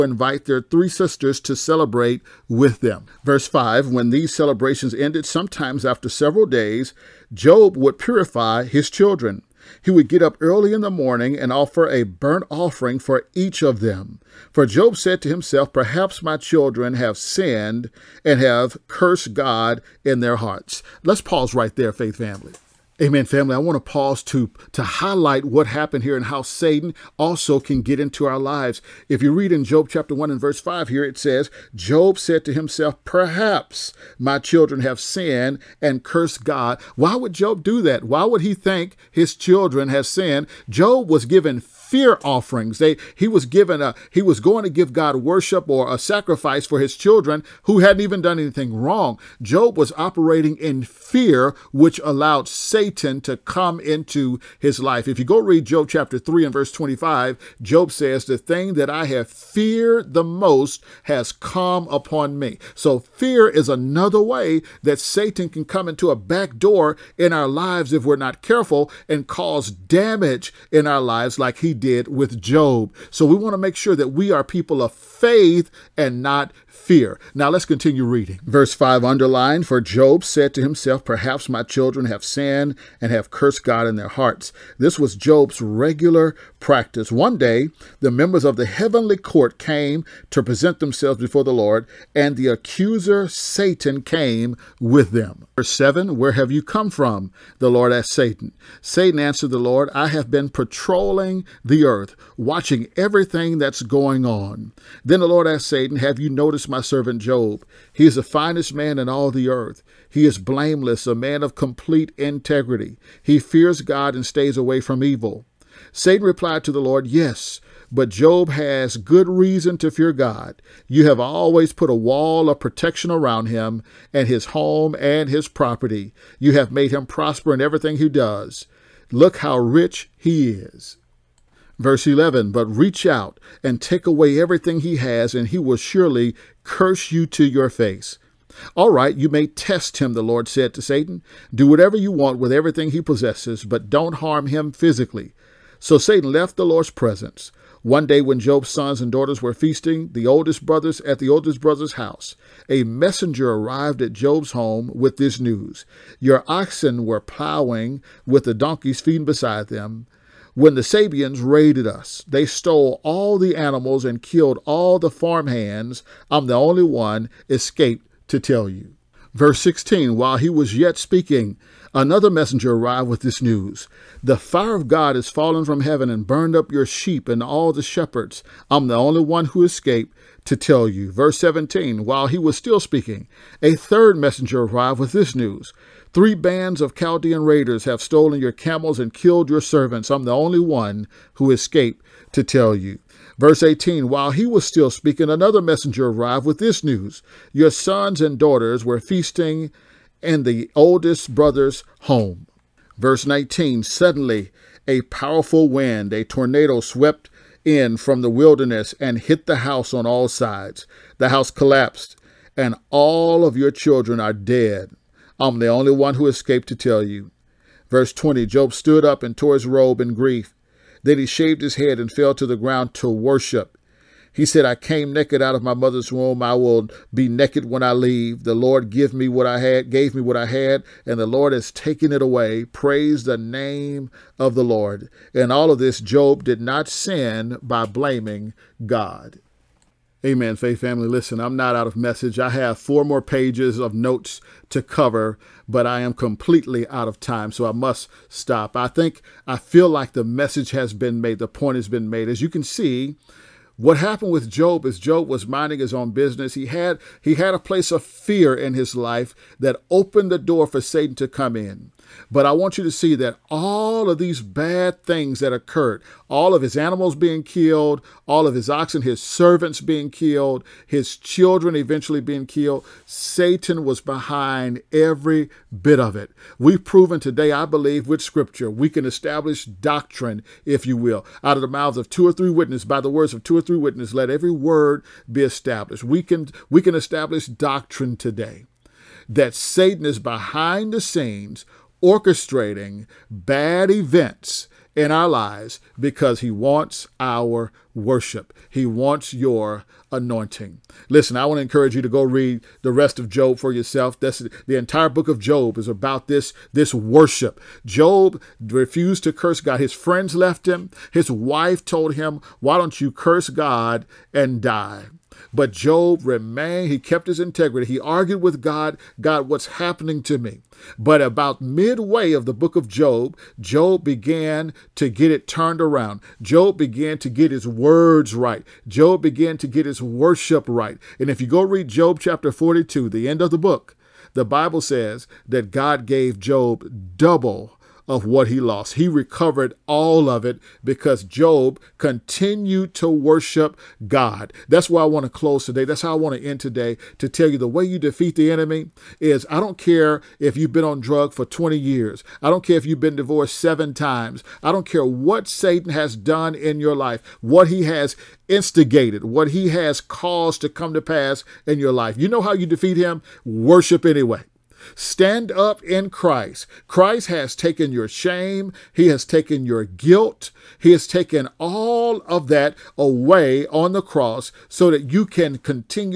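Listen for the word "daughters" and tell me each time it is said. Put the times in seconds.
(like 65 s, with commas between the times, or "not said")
149 s, 198 s.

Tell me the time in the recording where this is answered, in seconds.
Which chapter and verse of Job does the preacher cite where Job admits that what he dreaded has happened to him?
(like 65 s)
55 s.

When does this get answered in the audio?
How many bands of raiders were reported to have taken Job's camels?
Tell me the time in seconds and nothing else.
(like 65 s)
186 s.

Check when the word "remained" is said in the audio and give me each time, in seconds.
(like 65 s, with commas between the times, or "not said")
316 s.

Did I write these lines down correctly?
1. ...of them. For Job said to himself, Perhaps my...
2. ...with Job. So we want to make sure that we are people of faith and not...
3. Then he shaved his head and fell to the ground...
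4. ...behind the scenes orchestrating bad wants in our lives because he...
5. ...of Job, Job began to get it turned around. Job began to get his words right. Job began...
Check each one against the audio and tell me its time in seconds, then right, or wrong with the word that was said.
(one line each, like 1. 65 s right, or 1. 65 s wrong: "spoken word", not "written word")
1. 13 s right
2. 72 s right
3. 221 s right
4. 290 s wrong: "events", not "wants"
5. 322 s right.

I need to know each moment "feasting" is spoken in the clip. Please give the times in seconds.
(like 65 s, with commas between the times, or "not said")
149 s, 198 s.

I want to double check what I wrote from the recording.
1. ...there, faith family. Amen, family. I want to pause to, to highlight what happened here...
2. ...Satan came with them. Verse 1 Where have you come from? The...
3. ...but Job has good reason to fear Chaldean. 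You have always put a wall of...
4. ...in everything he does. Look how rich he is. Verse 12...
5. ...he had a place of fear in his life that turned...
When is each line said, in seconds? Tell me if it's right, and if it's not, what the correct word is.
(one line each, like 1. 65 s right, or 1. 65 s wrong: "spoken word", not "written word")
1. 21 s right
2. 93 s wrong: "7", not "1"
3. 117 s wrong: "God", not "Chaldean"
4. 127 s wrong: "11", not "12"
5. 257 s wrong: "opened", not "turned".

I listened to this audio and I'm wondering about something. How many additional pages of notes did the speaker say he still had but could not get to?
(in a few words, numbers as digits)
4.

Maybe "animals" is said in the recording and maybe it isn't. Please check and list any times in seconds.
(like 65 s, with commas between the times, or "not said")
163 s, 266 s.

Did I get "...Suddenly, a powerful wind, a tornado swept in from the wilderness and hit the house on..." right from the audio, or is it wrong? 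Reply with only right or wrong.
right.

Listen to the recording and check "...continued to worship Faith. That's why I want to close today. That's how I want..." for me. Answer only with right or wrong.
wrong.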